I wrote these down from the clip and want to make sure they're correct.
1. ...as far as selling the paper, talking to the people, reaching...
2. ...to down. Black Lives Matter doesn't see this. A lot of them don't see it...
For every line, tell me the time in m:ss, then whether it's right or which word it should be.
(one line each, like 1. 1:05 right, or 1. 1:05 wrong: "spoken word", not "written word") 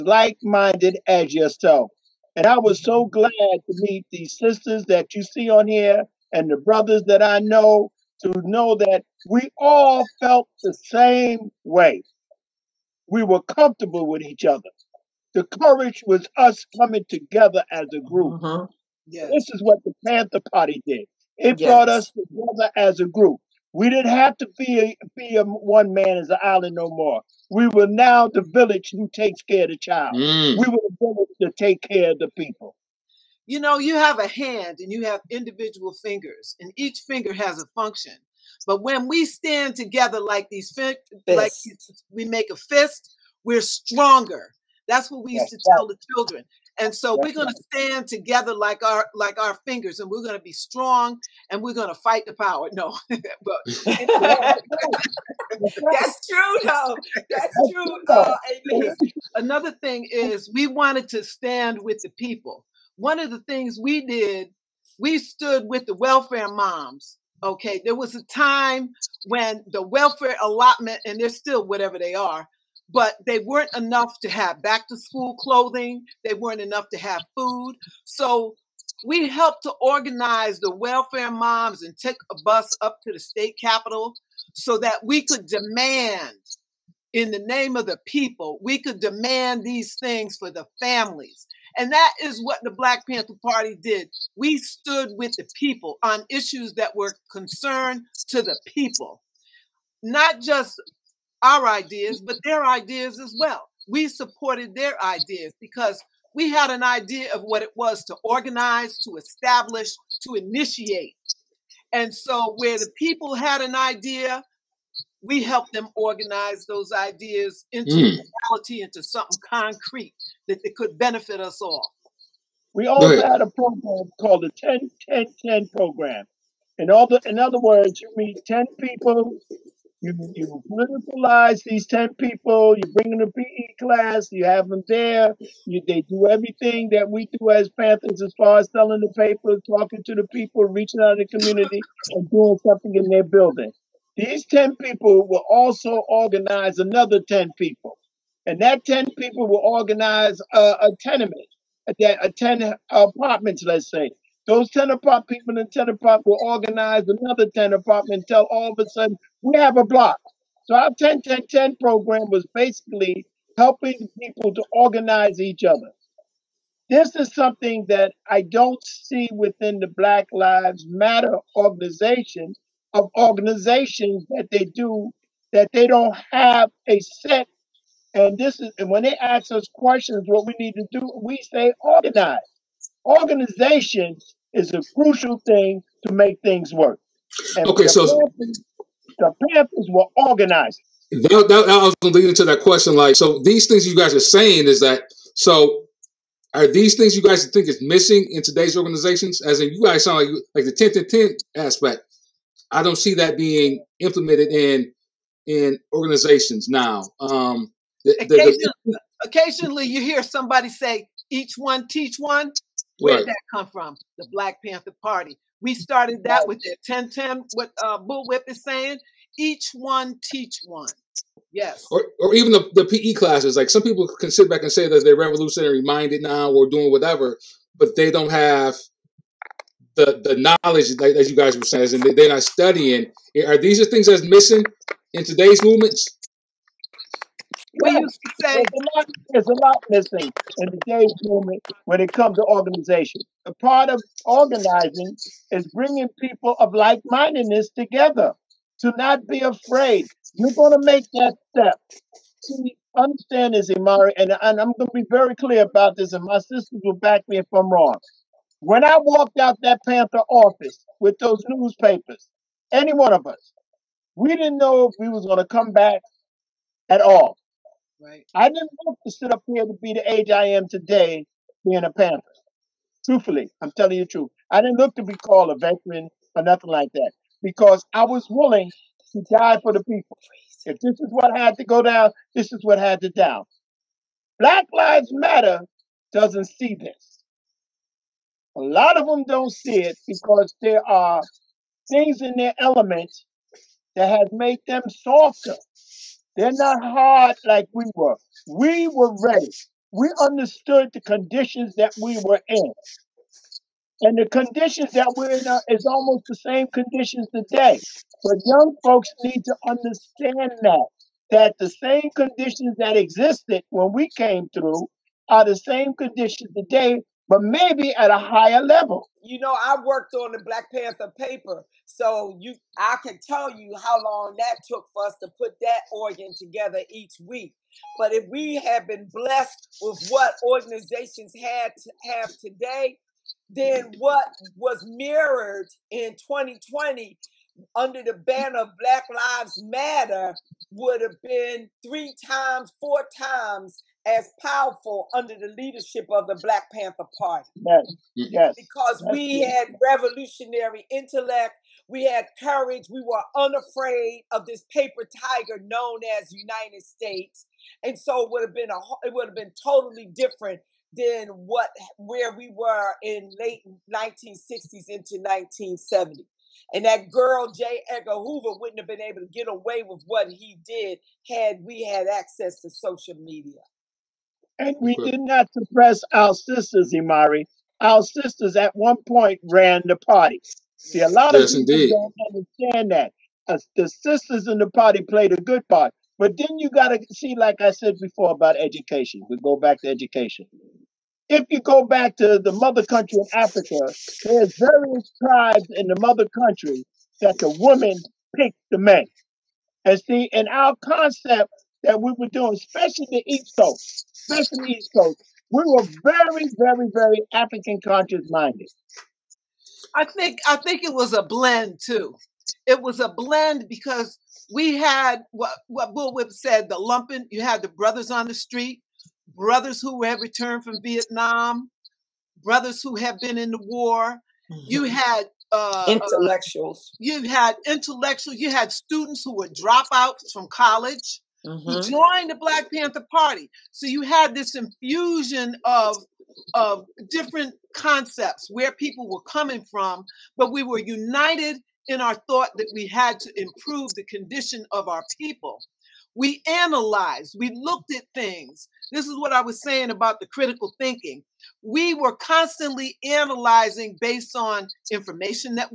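1. 2:18 right
2. 4:43 right.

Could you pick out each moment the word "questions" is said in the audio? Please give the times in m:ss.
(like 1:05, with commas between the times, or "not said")
2:59, 3:12.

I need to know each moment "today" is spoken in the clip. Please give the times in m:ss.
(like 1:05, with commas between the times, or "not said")
3:18, 3:55, 4:00, 4:30, 5:07, 5:16, 5:32.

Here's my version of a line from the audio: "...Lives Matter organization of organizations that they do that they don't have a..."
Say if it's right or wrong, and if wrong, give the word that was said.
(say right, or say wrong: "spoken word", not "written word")
right.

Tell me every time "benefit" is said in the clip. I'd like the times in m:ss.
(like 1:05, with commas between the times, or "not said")
2:00.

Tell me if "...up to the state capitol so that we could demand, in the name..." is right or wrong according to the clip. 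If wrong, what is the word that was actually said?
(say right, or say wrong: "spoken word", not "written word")
right.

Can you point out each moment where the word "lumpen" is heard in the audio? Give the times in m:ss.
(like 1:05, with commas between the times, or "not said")
6:56.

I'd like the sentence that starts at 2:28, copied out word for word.
And that 10 people will organize a, a tenement, a 10 apartments, let's say.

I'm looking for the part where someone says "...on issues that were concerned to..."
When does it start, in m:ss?
1:36.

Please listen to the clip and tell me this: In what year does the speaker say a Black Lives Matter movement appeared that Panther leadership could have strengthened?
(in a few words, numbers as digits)
2020.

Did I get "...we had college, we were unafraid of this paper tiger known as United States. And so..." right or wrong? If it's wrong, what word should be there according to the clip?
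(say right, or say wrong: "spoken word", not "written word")
wrong: "courage", not "college".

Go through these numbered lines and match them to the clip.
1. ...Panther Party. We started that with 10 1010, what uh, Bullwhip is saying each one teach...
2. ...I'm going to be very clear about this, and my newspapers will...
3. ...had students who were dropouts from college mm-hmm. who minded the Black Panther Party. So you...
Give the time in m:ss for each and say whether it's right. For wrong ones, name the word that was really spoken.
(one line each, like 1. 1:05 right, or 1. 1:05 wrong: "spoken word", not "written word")
1. 3:34 right
2. 4:14 wrong: "sisters", not "newspapers"
3. 7:08 wrong: "joined", not "minded".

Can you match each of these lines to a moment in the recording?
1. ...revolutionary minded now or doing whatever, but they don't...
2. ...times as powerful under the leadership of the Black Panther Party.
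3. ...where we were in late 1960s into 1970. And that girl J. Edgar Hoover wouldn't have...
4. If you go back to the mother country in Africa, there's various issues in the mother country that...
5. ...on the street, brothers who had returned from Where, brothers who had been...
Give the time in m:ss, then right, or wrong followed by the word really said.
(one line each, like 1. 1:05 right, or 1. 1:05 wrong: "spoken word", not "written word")
1. 3:45 right
2. 5:43 right
3. 6:01 right
4. 6:31 wrong: "tribes", not "issues"
5. 6:58 wrong: "Vietnam", not "Where".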